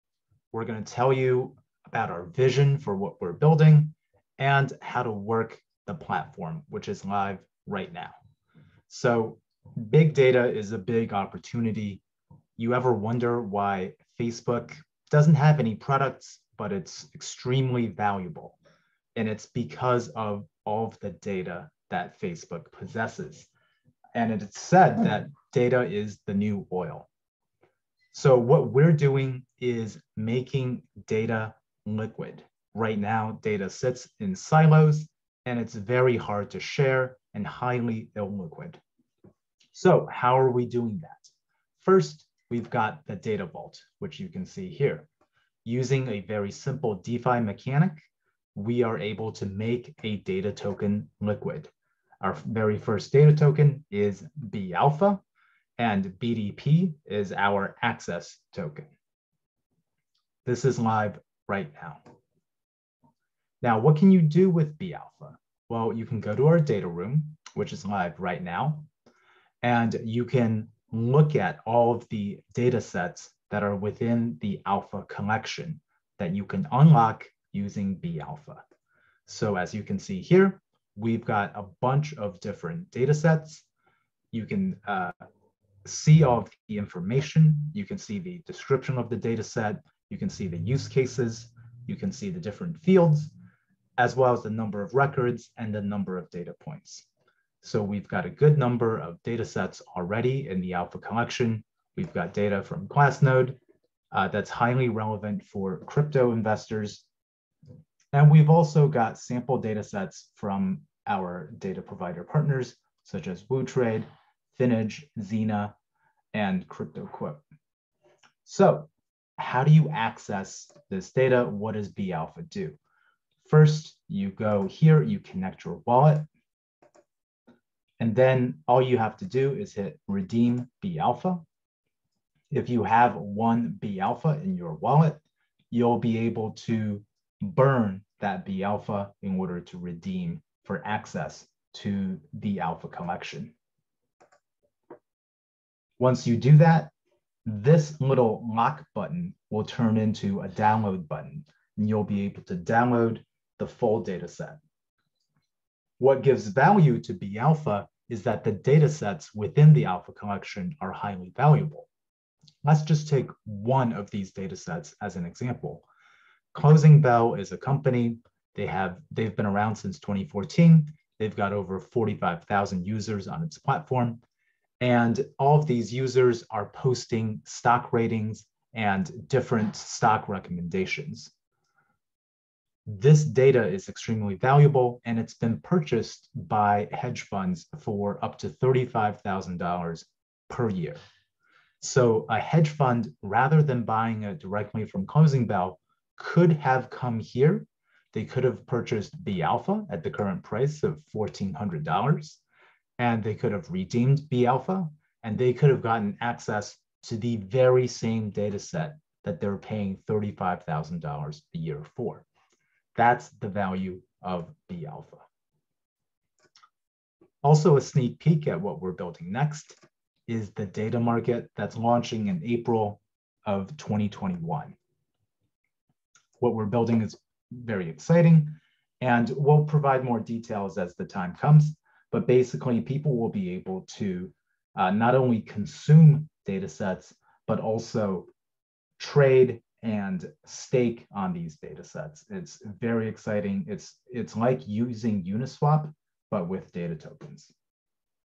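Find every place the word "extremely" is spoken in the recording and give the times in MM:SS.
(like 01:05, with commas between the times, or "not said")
00:17, 03:03.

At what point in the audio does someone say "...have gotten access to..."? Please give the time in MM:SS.
03:25.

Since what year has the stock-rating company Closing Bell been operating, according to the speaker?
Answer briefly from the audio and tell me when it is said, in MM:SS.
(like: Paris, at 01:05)
2014, at 02:49.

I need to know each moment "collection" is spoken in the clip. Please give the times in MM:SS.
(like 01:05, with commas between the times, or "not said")
01:15, 01:40, 02:22, 02:40.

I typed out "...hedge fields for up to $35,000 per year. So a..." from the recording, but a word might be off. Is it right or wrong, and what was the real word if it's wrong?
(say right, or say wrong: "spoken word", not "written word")
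wrong: "funds", not "fields".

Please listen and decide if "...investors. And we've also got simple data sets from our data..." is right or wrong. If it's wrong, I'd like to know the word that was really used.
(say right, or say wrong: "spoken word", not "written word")
wrong: "sample", not "simple".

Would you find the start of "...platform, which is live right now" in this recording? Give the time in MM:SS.
00:05.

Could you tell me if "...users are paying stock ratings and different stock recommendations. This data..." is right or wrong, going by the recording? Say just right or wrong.
wrong.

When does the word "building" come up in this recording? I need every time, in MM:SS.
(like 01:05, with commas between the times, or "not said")
00:03, 03:39, 03:46.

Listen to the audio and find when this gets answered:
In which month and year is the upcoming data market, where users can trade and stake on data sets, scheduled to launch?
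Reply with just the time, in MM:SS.
03:42.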